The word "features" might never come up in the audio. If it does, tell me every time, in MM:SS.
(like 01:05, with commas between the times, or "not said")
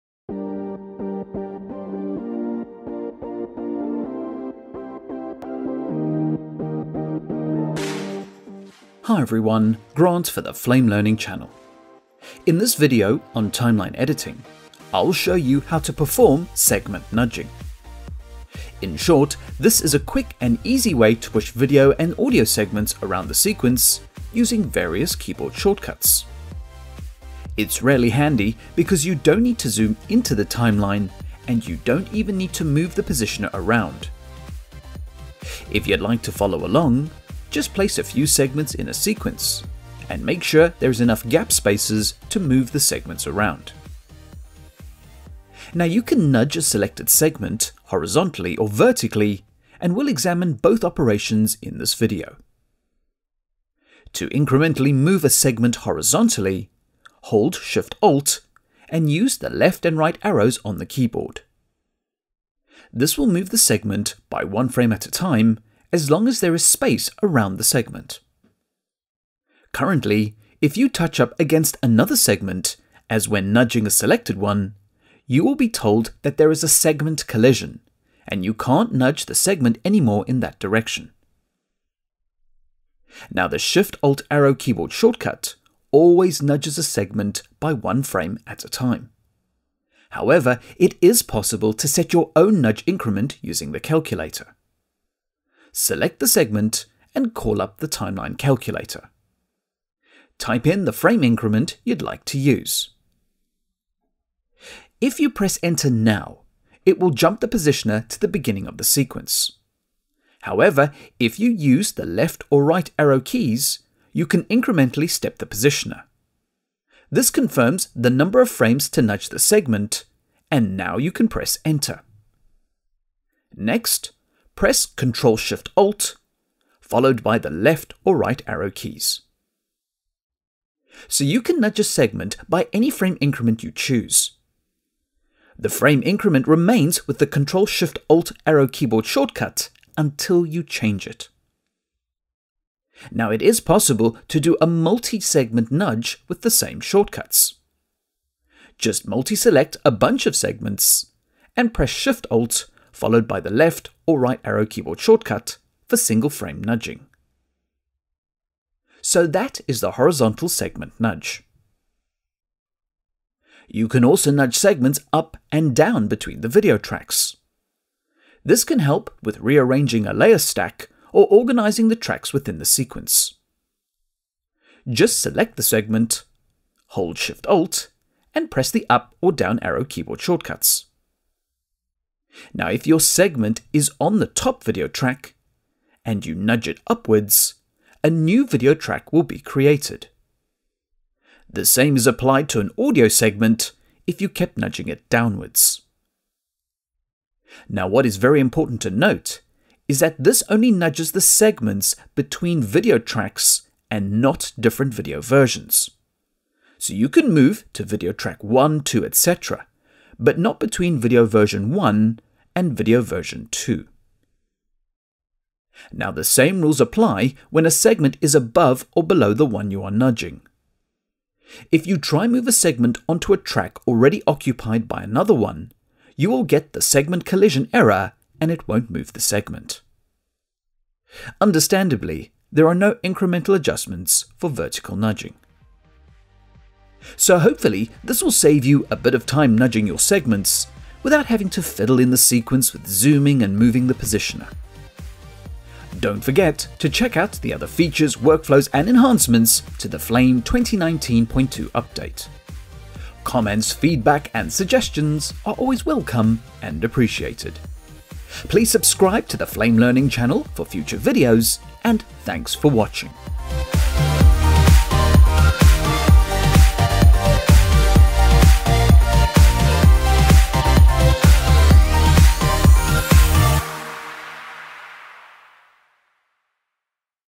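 04:07.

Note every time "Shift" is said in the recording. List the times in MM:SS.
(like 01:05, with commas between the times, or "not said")
00:57, 01:23, 02:05, 02:17, 02:31, 02:57.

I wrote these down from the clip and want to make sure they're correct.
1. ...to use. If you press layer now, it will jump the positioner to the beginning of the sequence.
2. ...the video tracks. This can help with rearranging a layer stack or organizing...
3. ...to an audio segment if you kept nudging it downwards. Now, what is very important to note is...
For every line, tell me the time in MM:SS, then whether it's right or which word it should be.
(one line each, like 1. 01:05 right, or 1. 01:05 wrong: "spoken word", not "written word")
1. 01:42 wrong: "enter", not "layer"
2. 02:46 right
3. 03:12 right.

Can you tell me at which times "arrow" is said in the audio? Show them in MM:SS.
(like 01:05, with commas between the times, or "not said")
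01:00, 01:24, 01:52, 02:08, 02:18, 02:34, 02:59.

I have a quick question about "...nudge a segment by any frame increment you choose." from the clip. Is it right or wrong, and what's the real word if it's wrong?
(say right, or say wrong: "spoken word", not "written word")
right.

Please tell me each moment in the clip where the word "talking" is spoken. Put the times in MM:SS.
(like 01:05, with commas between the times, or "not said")
not said.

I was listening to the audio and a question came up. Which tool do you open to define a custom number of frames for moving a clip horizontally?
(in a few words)
timeline calculator.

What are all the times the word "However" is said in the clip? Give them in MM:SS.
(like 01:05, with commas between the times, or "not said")
01:30, 01:50.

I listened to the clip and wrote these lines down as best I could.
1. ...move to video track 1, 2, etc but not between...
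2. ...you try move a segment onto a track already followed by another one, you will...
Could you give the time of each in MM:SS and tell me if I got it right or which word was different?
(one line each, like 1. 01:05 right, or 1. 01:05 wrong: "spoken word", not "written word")
1. 03:27 right
2. 03:41 wrong: "occupied", not "followed".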